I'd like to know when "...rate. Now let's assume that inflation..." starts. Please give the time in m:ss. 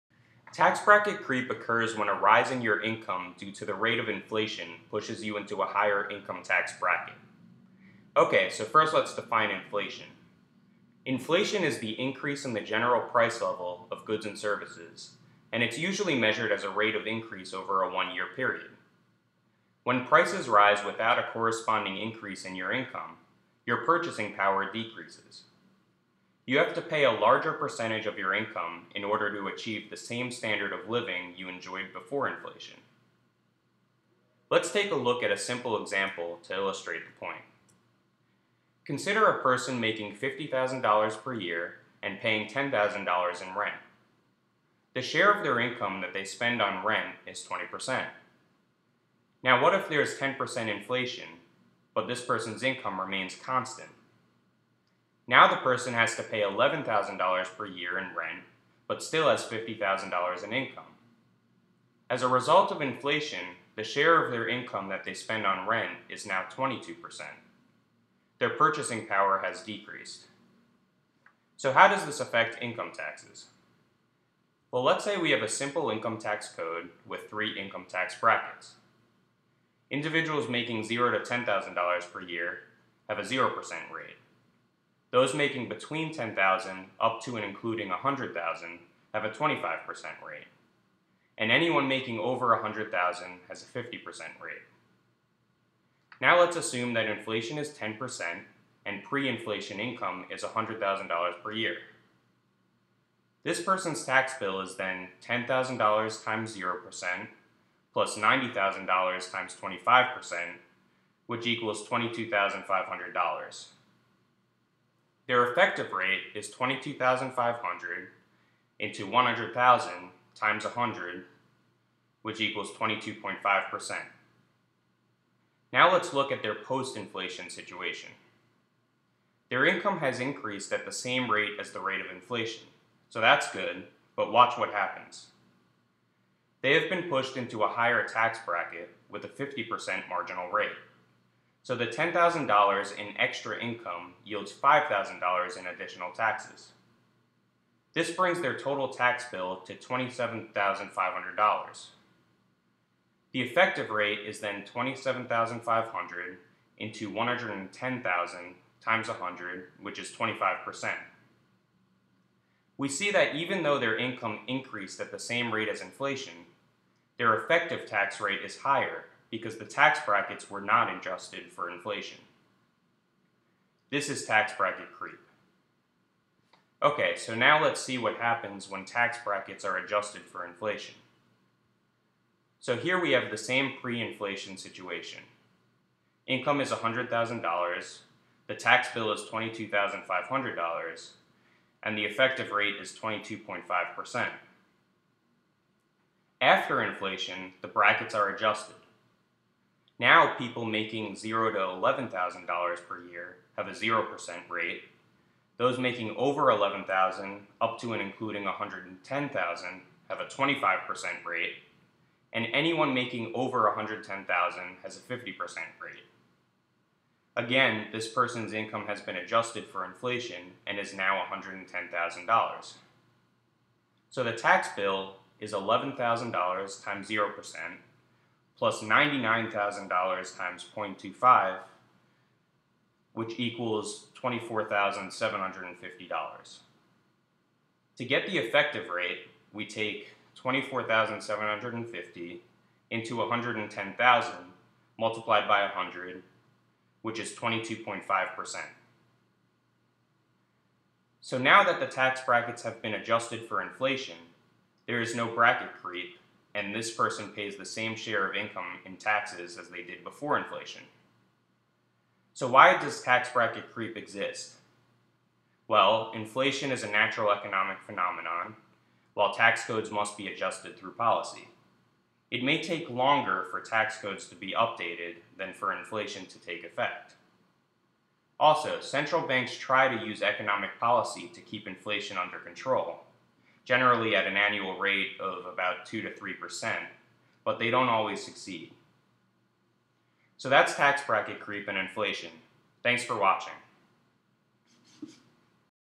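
1:34.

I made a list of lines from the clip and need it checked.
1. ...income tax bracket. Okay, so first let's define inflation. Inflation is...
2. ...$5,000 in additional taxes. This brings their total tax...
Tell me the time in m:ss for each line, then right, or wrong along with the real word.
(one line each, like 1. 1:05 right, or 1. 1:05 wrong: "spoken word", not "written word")
1. 0:06 right
2. 2:24 right.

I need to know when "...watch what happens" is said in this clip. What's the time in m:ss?
2:14.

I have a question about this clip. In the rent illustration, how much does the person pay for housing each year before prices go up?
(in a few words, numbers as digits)
$10,000.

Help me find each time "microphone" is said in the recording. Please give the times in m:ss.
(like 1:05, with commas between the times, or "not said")
not said.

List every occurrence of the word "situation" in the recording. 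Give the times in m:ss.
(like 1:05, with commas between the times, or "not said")
2:07, 3:04.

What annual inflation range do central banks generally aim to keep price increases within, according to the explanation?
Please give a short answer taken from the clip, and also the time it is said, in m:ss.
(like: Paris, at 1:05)
2 to 3%, at 4:45.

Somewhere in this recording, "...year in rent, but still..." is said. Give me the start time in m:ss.
0:57.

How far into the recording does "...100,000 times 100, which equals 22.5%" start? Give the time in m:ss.
1:59.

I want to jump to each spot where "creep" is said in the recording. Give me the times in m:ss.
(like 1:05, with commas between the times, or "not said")
0:01, 2:54, 4:23, 4:51.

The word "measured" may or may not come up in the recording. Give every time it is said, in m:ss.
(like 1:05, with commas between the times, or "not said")
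0:16.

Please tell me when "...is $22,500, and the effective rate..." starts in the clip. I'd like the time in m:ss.
3:09.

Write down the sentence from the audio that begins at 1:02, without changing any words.
As a result of inflation, the share of their income that they spend on rent is now 22%.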